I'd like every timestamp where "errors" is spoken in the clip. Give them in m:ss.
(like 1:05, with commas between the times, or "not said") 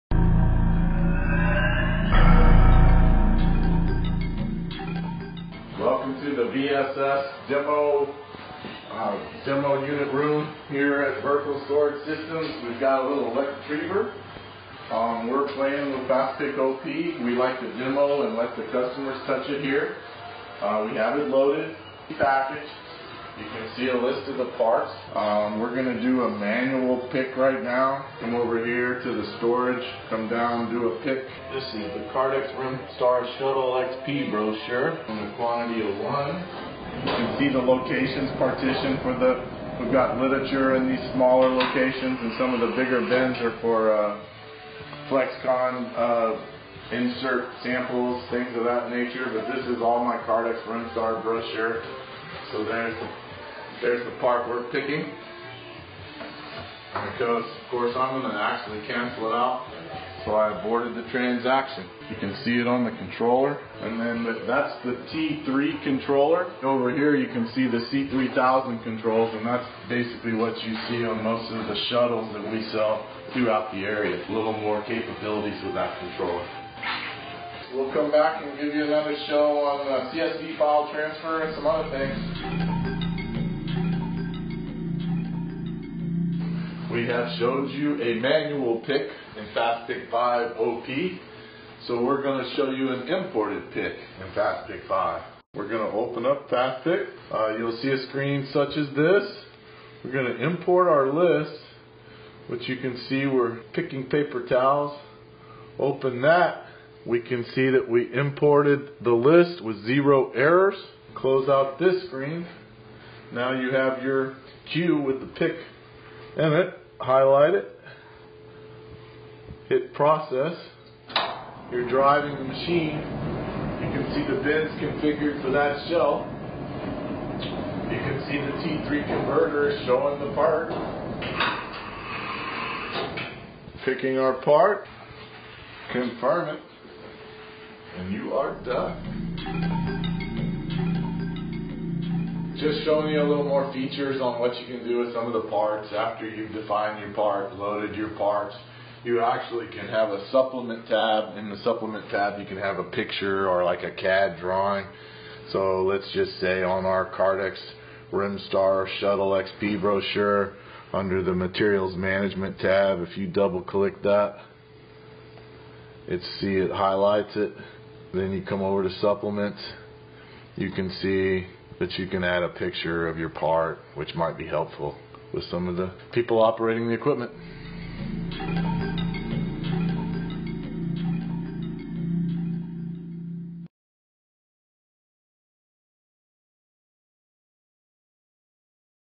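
1:50.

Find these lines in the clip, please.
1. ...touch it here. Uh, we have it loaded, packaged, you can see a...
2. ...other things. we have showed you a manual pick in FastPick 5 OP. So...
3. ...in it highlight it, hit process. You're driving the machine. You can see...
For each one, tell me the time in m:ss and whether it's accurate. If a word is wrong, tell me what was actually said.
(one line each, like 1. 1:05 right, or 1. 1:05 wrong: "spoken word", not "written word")
1. 0:19 right
2. 1:21 right
3. 1:56 right.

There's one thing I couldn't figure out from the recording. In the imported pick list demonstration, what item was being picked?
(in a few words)
Paper towels.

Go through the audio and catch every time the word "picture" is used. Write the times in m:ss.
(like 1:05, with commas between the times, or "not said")
2:32, 2:52.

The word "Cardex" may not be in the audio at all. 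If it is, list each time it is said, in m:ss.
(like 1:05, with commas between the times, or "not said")
0:32.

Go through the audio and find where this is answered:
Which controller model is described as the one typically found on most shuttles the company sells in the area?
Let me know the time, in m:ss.
1:07.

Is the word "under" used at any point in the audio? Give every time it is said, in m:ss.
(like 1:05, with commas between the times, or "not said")
2:40.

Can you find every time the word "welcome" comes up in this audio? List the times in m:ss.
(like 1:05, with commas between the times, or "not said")
0:06.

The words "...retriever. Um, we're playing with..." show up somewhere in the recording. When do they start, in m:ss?
0:13.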